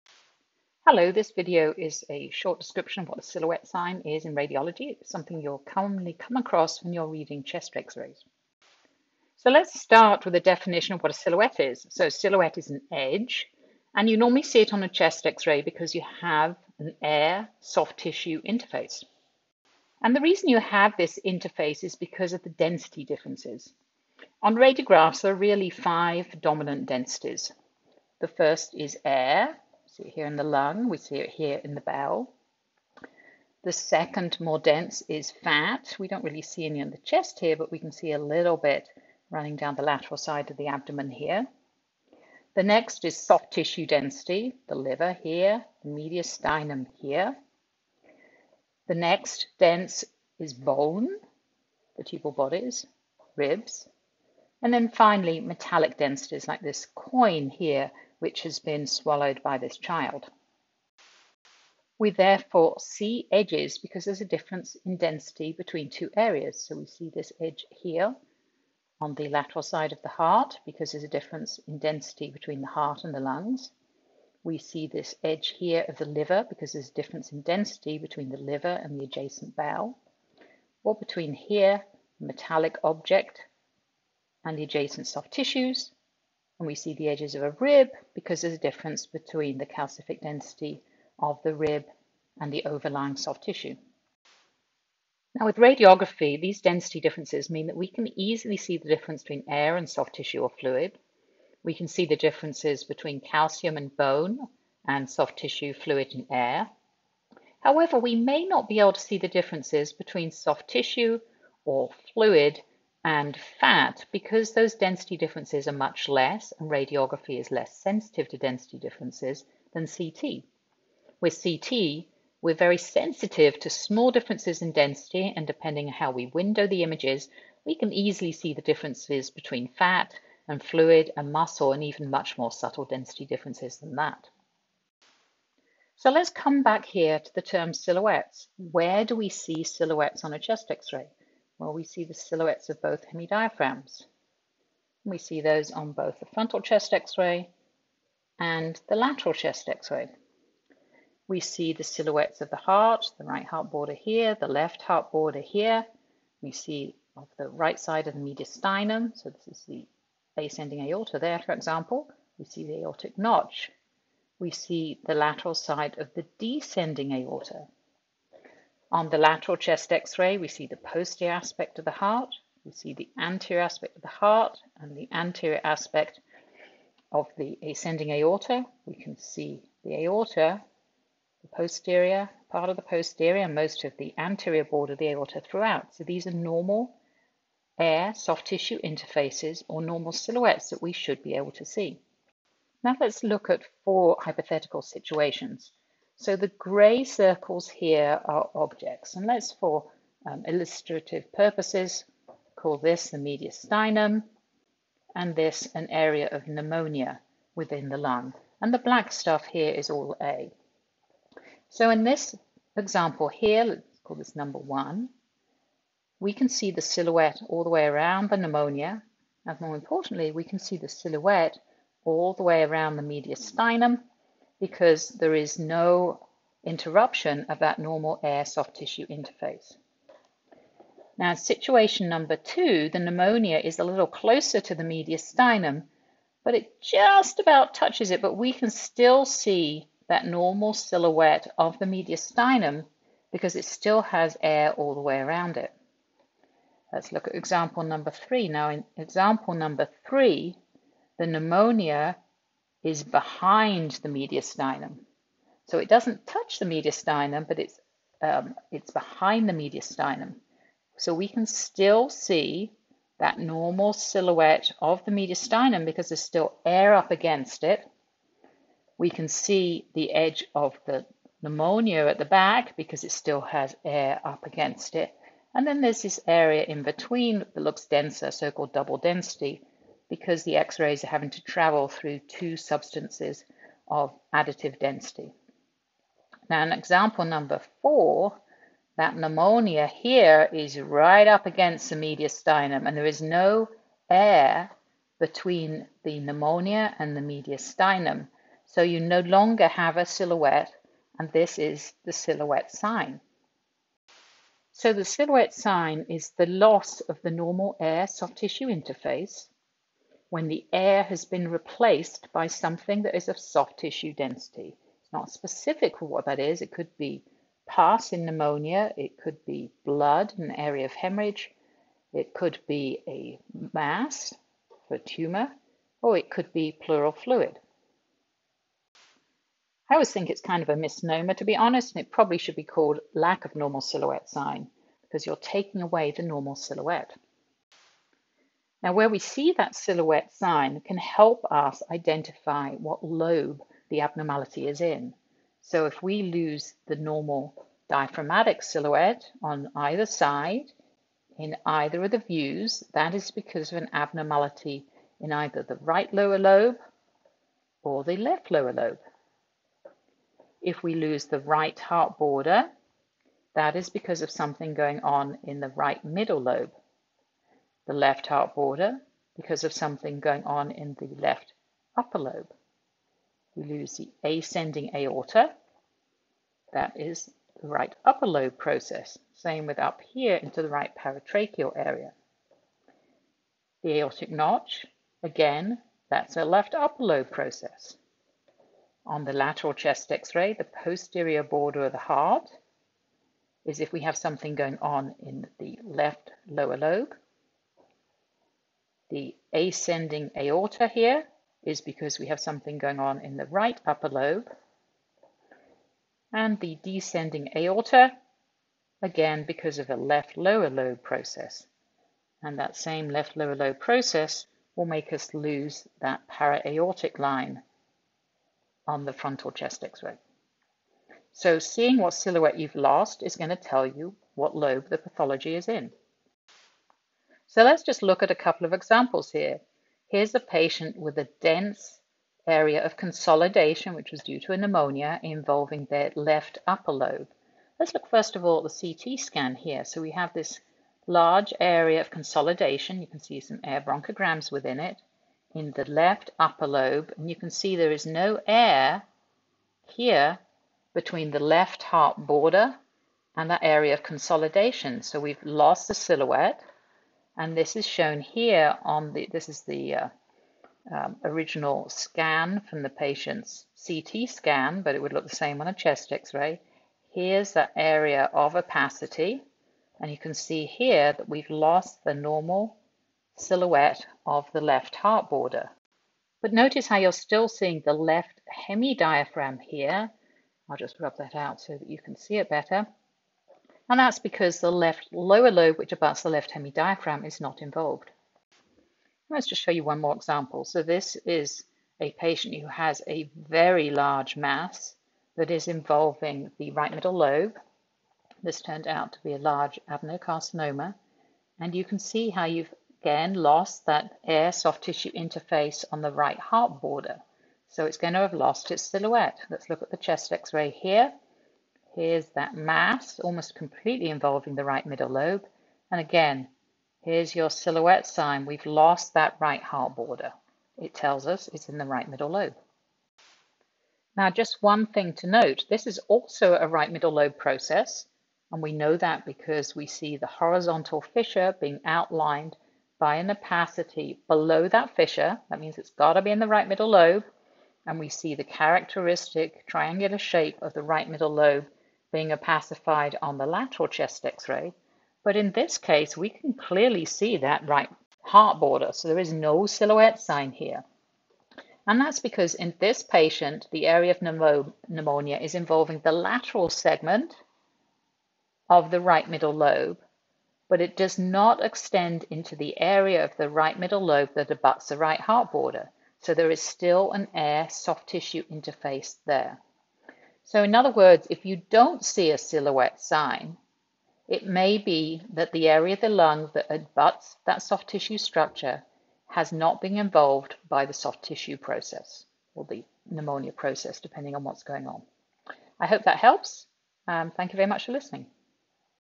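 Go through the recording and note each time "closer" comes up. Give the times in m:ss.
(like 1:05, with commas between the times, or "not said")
3:54.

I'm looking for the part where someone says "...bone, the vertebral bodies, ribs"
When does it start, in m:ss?
0:50.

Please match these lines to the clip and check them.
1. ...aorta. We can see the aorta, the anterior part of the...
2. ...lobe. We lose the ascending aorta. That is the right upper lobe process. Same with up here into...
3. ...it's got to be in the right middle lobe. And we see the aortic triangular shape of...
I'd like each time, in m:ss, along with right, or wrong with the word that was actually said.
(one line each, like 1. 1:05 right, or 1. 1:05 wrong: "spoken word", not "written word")
1. 2:58 wrong: "posterior", not "anterior"
2. 6:12 right
3. 8:55 wrong: "characteristic", not "aortic".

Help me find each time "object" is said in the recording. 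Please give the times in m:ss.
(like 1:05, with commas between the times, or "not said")
1:22, 3:18.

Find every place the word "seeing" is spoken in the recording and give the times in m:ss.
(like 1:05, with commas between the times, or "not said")
7:01, 7:57.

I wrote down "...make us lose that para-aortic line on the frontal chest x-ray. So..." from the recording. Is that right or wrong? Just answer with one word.
right.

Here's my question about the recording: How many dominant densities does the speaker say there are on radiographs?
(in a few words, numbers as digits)
5.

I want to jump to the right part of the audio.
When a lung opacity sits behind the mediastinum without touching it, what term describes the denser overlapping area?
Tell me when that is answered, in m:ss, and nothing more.
4:38.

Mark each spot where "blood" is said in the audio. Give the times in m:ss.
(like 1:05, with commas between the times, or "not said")
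5:19.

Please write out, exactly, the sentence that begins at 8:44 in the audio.
Now, just one thing to note, this is also a right middle lobe process.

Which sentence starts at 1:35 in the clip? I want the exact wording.
Now with radiography, these density differences mean that we can easily see the difference between air and soft tissue or fluid.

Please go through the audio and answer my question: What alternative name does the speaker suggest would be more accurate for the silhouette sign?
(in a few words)
lack of normal silhouette sign.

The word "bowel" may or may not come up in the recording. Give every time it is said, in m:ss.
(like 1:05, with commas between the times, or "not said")
0:31, 1:19.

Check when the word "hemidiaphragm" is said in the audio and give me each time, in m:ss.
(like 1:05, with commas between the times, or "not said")
2:23, 7:58, 8:06.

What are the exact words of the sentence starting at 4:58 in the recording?
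So you no longer have a silhouette, and this is the silhouette sign.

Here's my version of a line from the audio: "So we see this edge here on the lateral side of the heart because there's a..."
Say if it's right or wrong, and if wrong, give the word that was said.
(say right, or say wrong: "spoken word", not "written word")
right.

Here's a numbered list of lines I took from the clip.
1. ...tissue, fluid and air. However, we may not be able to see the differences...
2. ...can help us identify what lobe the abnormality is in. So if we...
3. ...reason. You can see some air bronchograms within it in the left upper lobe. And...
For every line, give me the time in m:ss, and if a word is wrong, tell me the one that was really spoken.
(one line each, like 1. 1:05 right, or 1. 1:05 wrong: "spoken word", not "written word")
1. 1:45 right
2. 5:40 right
3. 7:22 wrong: "consolidation", not "reason".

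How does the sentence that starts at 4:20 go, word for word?
So we can still see that normal silhouette of the mediastinum because there's still air up against it.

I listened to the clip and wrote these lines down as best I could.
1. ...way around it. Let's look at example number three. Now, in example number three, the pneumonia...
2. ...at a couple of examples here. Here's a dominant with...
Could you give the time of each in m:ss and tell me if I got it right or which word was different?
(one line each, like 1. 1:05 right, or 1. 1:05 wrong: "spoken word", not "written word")
1. 4:05 right
2. 7:08 wrong: "patient", not "dominant".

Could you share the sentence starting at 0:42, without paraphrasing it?
The next is soft tissue density, the liver here, the mediastinum here.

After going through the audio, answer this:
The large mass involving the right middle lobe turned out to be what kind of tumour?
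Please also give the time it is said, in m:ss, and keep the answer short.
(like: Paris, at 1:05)
adenocarcinoma, at 8:19.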